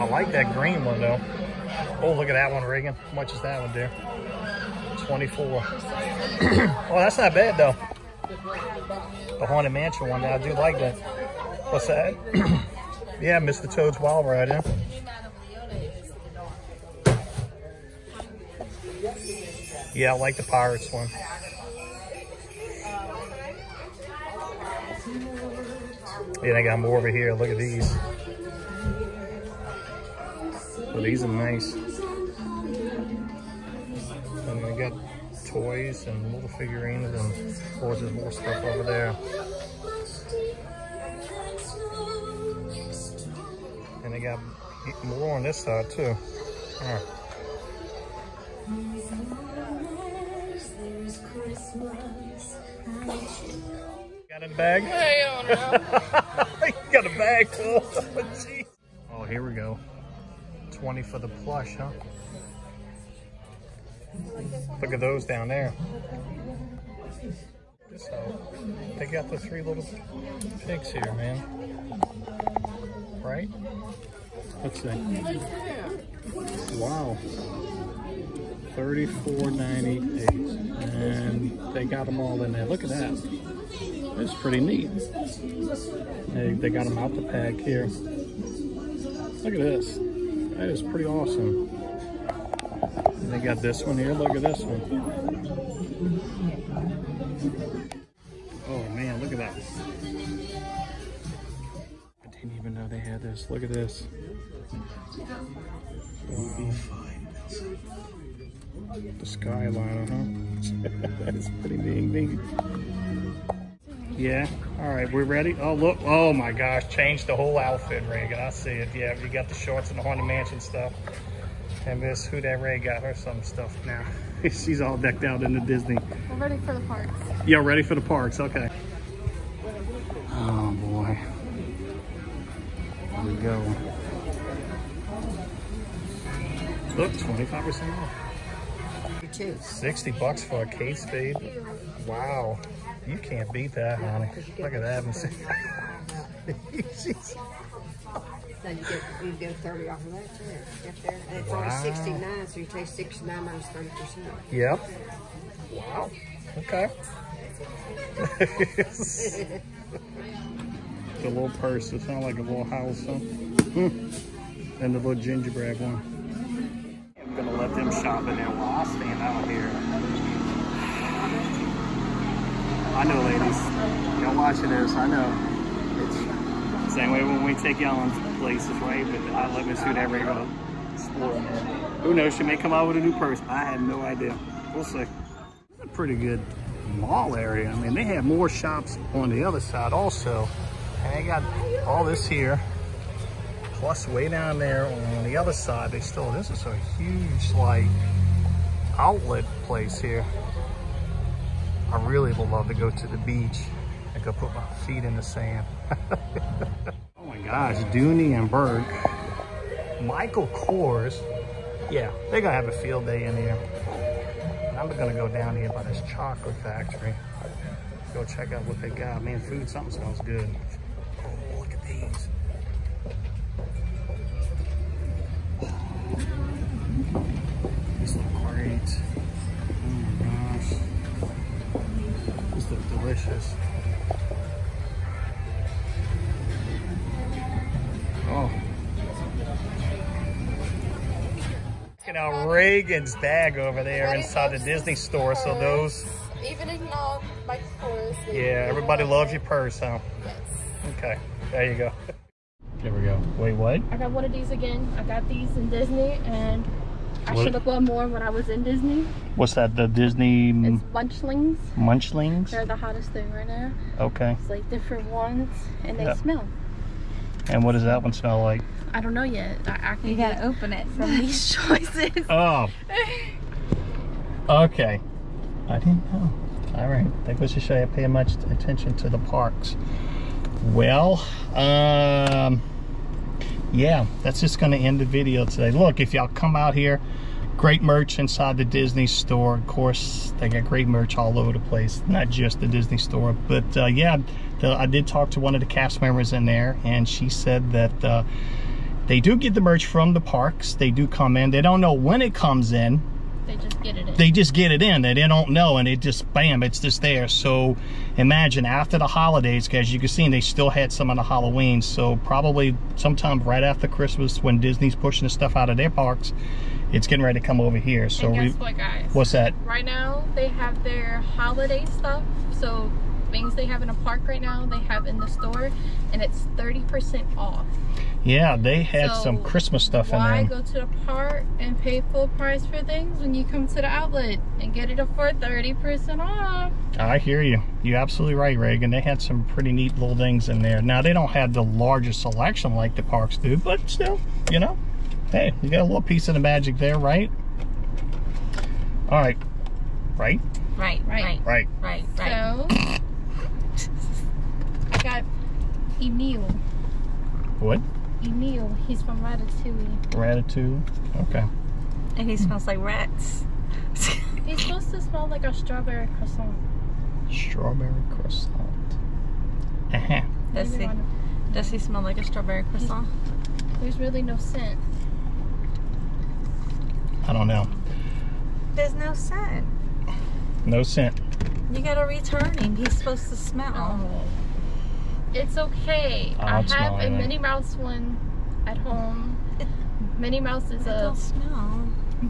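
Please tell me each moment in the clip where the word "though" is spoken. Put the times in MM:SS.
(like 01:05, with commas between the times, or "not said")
00:01, 00:07.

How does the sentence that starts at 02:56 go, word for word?
It's same way when we take y'all in places, right?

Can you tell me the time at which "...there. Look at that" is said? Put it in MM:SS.
01:22.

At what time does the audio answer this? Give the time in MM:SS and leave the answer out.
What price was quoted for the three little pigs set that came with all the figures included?
01:18.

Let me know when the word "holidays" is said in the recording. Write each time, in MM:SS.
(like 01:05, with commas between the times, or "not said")
05:09, 05:21.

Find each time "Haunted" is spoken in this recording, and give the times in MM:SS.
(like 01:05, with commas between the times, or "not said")
00:09, 02:00.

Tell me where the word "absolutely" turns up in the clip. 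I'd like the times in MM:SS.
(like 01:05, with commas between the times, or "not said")
05:37.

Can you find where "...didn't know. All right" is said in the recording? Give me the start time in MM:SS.
04:35.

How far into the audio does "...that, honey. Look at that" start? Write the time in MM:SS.
02:23.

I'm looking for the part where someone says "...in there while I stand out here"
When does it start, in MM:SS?
02:48.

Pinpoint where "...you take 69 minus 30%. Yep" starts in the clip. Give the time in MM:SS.
02:32.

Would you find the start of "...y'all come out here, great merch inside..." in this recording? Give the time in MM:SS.
04:46.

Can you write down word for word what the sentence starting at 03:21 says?
I really would love to go to the beach.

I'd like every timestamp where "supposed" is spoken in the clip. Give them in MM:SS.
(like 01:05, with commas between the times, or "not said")
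06:04, 06:22.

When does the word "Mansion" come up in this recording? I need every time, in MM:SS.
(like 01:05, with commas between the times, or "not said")
00:09, 02:00.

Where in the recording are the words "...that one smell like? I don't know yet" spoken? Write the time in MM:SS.
04:27.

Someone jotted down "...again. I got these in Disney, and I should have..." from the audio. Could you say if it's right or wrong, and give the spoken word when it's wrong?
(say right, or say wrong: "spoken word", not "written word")
right.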